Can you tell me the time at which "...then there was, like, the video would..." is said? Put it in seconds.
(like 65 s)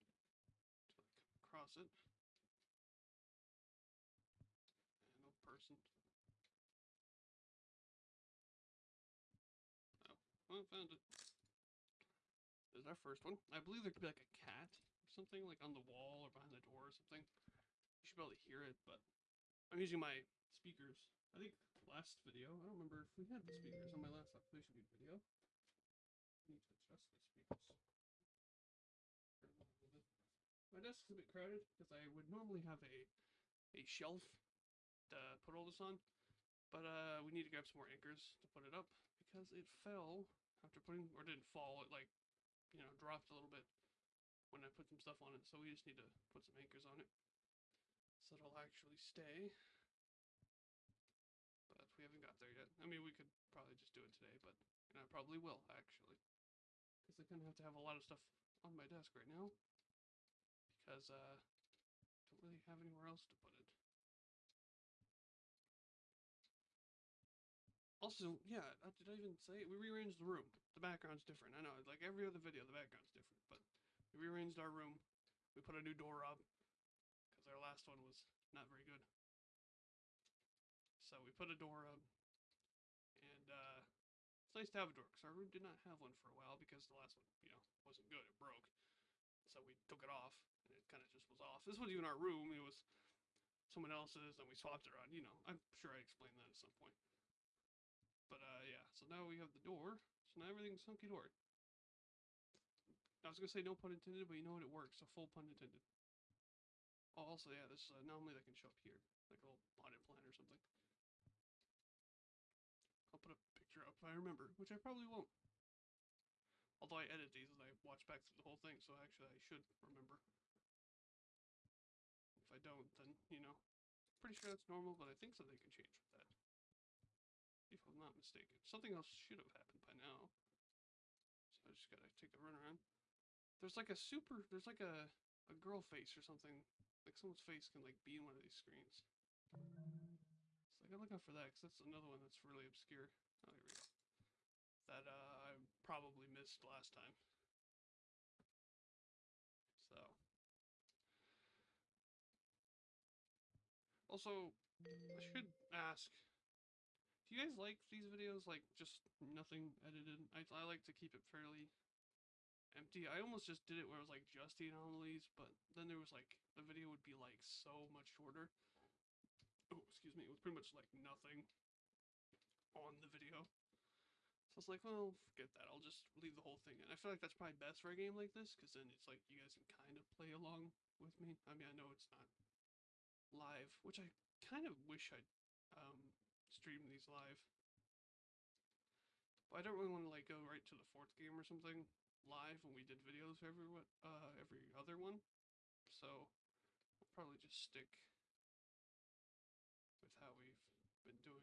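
165 s.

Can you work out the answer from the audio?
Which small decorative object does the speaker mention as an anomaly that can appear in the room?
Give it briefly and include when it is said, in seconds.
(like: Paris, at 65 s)
Potted plant, at 109 s.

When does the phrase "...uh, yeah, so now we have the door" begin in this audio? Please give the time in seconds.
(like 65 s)
98 s.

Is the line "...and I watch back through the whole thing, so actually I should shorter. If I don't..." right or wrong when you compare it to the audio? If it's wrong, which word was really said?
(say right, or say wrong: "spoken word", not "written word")
wrong: "remember", not "shorter".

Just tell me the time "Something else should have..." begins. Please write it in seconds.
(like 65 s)
128 s.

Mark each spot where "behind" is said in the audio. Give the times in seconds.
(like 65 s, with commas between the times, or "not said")
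16 s.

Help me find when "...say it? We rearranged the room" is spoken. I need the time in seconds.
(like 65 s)
69 s.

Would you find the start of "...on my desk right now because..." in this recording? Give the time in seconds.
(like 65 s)
58 s.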